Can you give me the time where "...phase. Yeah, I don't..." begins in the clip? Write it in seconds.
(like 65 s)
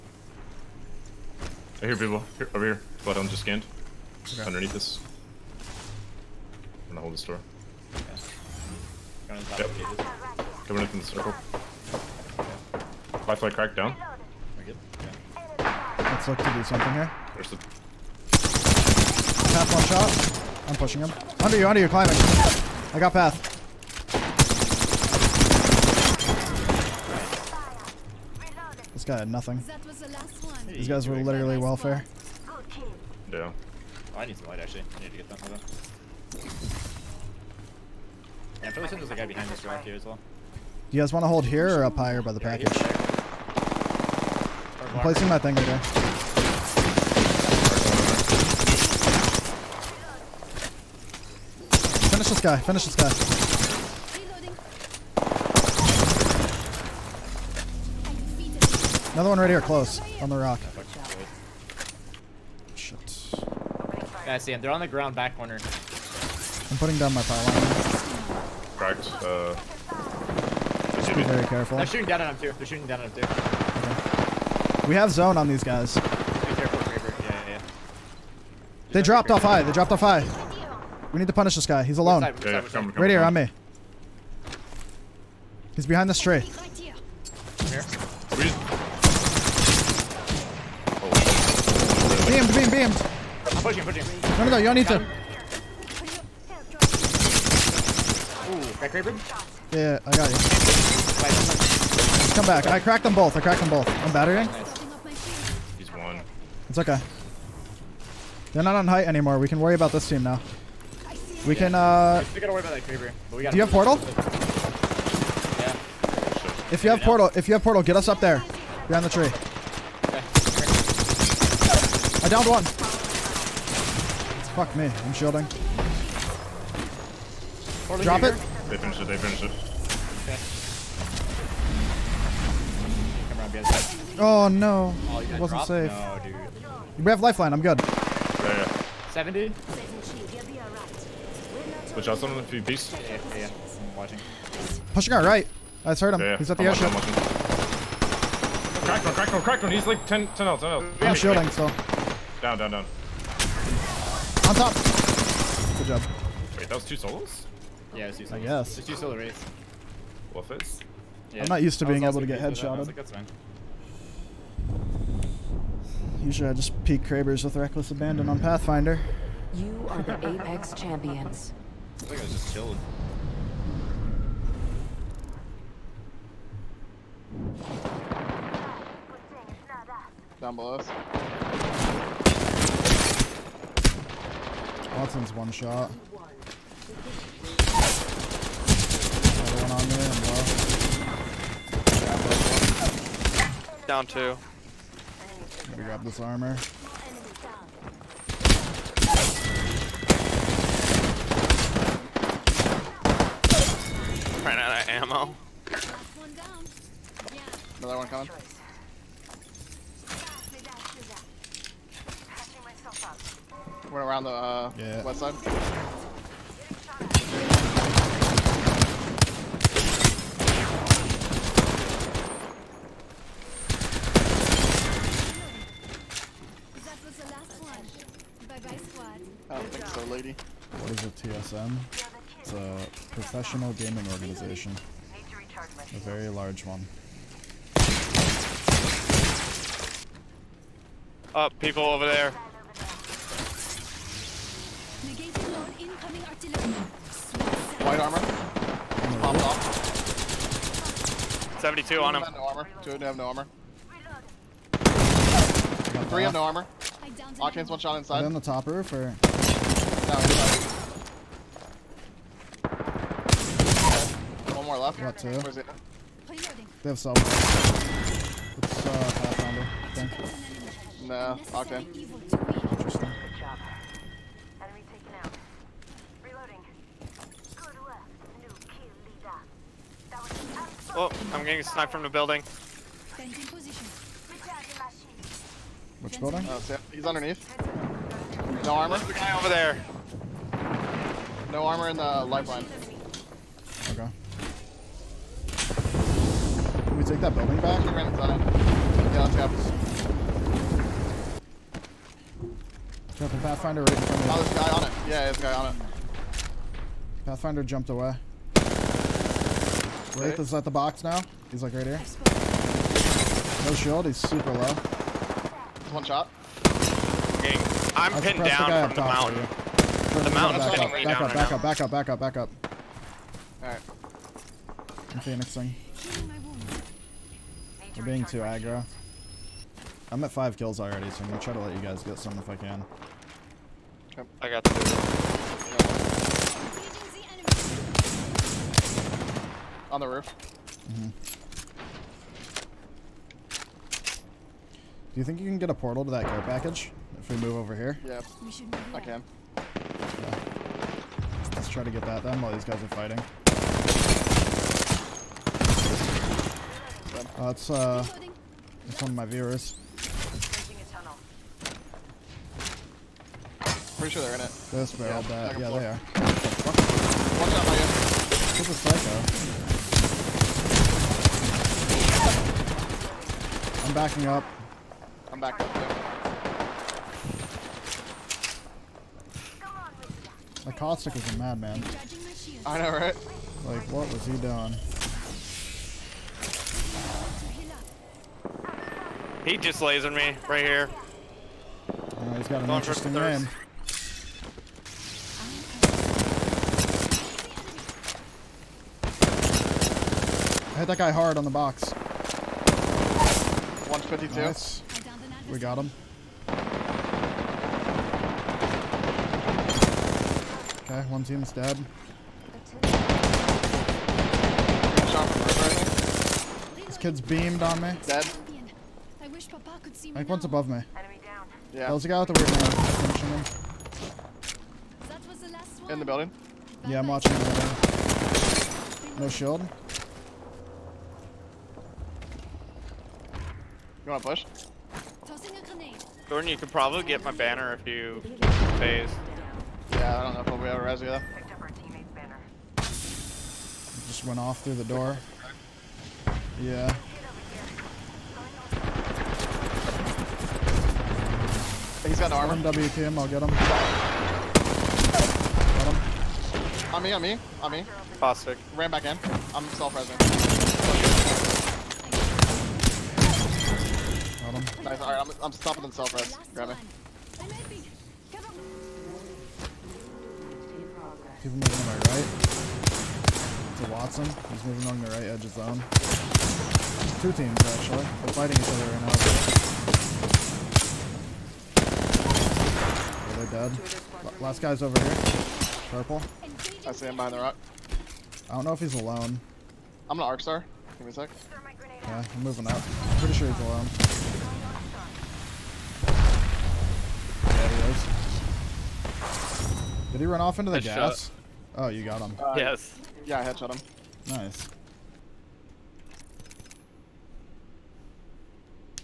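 438 s.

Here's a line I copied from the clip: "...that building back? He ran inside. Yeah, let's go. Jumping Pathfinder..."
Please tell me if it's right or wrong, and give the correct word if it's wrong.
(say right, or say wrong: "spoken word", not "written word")
right.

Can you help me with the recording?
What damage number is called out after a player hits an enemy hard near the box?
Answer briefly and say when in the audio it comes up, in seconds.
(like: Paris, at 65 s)
52, at 404 s.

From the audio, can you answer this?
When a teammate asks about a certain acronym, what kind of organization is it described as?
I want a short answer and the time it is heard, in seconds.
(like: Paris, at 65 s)
Professional gaming organization, at 233 s.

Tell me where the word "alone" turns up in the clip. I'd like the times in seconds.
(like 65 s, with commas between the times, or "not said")
81 s, 488 s, 493 s.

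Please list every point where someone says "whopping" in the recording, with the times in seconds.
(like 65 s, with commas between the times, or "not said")
not said.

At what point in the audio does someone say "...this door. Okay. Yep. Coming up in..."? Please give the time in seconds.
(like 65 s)
7 s.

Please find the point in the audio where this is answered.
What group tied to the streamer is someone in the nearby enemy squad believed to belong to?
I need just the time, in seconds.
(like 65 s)
359 s.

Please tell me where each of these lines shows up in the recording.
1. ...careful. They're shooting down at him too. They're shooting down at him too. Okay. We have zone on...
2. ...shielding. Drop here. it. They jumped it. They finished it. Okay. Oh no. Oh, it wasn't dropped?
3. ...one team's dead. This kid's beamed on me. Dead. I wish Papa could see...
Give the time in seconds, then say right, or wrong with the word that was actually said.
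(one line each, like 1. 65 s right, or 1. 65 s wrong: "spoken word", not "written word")
1. 71 s right
2. 125 s wrong: "finished", not "jumped"
3. 411 s right.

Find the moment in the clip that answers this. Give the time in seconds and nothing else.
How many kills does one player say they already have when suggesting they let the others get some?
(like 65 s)
330 s.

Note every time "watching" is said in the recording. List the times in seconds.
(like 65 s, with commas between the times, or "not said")
143 s, 427 s.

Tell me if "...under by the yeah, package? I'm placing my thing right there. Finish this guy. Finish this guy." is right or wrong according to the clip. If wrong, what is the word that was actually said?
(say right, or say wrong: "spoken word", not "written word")
wrong: "higher", not "under".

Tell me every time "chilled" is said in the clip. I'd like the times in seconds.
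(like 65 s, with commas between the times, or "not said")
172 s.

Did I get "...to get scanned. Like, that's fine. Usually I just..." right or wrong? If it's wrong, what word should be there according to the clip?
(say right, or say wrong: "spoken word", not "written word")
wrong: "headshotted", not "scanned".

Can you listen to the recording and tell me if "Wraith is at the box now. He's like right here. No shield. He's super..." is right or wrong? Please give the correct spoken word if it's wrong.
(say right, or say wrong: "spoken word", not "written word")
right.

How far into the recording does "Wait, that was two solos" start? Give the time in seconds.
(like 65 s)
156 s.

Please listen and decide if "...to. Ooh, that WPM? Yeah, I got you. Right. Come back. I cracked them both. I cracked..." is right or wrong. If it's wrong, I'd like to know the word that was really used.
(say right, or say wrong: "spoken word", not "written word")
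wrong: "Kraber", not "WPM".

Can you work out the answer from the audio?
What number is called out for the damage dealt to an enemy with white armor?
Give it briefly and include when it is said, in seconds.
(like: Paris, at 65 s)
72, at 251 s.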